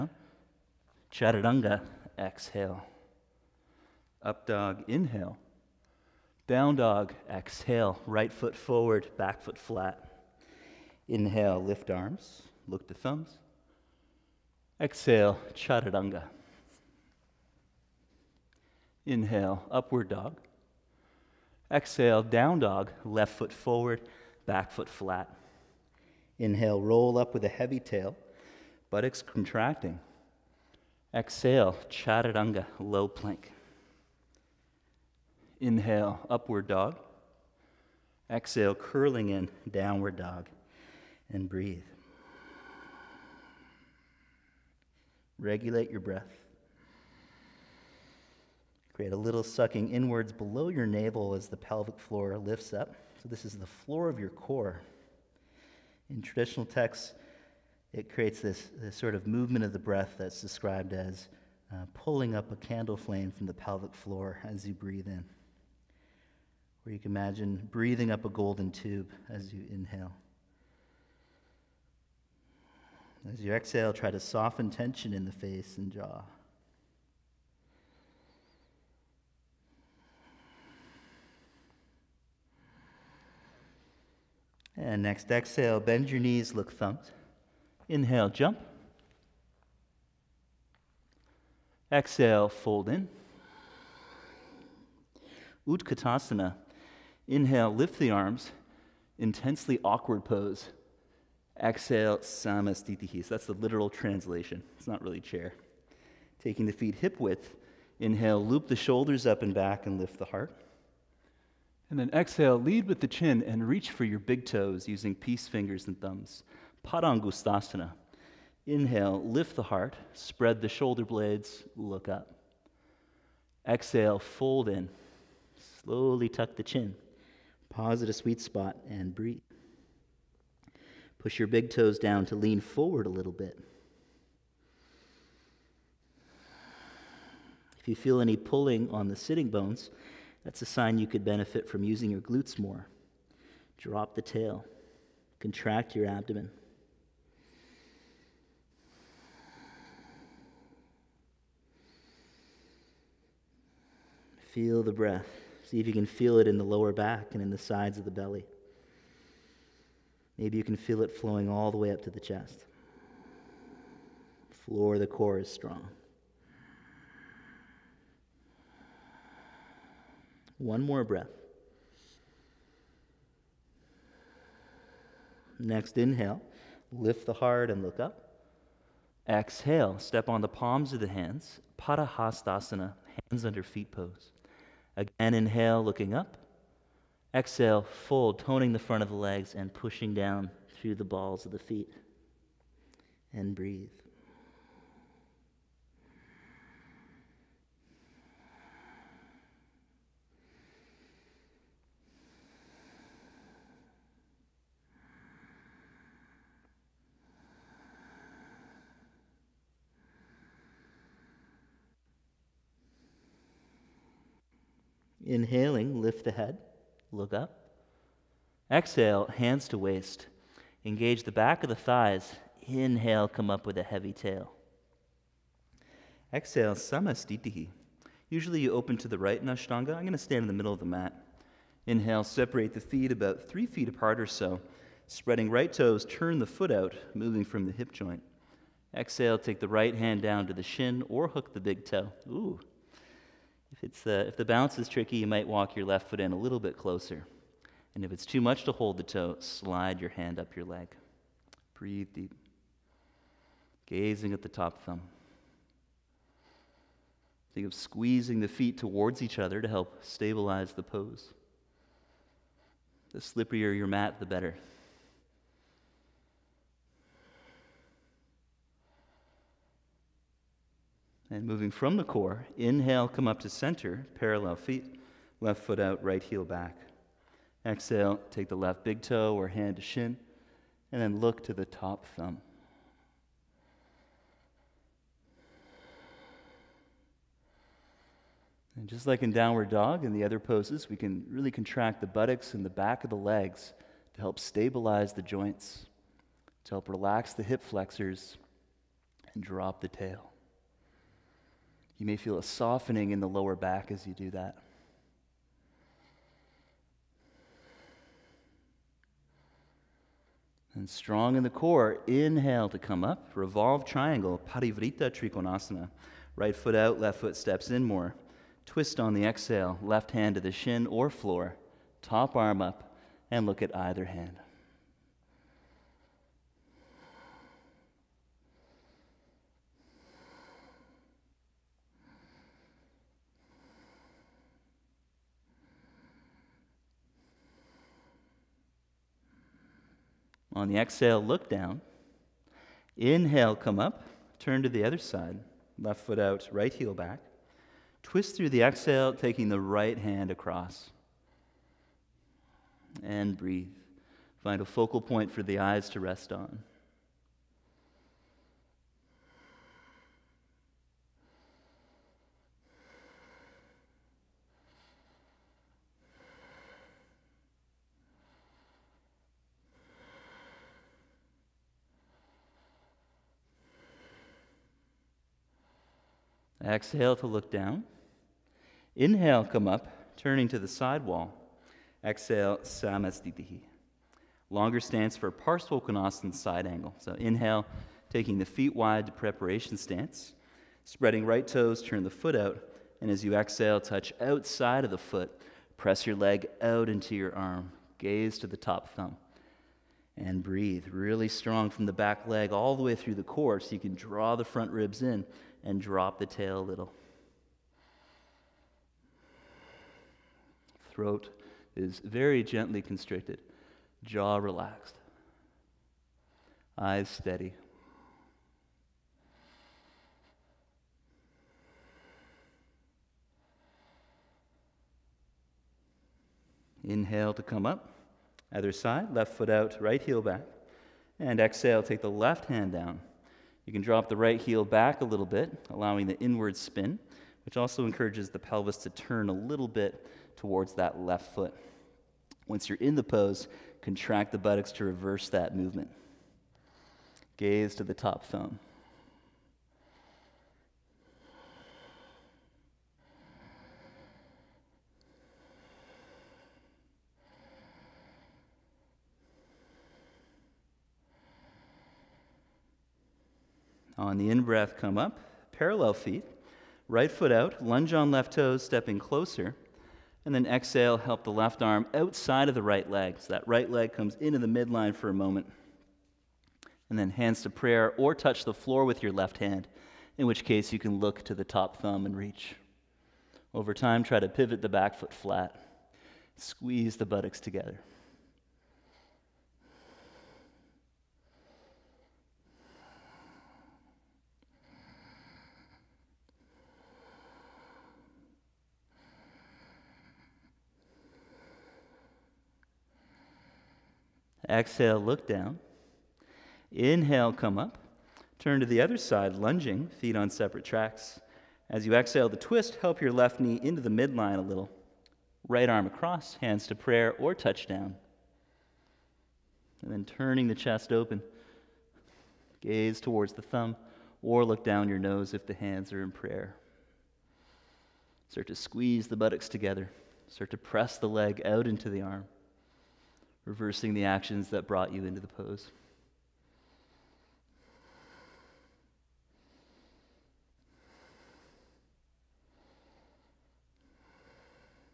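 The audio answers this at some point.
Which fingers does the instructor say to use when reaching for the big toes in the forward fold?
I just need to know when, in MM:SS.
01:55.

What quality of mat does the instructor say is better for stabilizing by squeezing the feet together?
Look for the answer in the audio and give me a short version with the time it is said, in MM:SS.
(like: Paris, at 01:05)
Slipperier, at 04:23.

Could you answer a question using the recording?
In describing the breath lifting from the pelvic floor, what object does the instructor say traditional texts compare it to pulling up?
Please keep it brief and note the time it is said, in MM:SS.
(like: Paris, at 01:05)
A candle flame, at 01:02.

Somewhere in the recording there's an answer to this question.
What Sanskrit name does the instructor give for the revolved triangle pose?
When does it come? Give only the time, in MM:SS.
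05:14.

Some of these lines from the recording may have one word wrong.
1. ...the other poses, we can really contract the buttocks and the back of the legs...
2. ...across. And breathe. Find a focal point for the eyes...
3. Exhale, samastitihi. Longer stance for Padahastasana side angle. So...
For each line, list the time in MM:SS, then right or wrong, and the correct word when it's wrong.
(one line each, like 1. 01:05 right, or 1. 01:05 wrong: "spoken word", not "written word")
1. 04:50 right
2. 05:50 right
3. 06:22 wrong: "Parsvakonasana", not "Padahastasana".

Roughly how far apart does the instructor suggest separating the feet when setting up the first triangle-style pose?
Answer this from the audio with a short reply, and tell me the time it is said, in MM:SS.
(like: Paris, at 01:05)
About 3 feet, at 03:53.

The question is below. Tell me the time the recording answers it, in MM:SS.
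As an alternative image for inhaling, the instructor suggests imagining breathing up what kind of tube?
01:08.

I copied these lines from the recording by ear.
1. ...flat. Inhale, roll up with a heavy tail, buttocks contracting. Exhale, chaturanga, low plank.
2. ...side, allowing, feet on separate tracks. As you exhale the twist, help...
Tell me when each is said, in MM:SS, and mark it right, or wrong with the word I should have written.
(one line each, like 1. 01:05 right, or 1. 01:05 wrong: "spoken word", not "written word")
1. 00:24 right
2. 08:28 wrong: "lunging", not "allowing".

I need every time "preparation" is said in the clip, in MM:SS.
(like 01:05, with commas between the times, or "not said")
06:29.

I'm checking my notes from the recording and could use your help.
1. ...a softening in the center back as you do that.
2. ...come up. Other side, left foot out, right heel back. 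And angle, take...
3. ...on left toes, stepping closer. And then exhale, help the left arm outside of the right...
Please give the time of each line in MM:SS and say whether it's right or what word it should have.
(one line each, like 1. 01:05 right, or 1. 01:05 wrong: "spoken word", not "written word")
1. 05:02 wrong: "lower", not "center"
2. 07:07 wrong: "exhale", not "angle"
3. 07:47 right.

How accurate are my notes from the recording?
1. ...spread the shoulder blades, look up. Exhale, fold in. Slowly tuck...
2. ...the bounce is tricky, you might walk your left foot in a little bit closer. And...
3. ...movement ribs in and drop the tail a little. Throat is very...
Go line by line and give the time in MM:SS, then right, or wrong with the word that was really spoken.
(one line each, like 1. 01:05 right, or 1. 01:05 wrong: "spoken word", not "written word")
1. 02:00 right
2. 04:04 right
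3. 06:44 wrong: "front", not "movement".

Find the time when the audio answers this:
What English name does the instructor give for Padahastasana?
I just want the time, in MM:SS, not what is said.
03:03.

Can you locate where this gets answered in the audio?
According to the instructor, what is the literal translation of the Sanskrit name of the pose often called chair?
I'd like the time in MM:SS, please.
01:39.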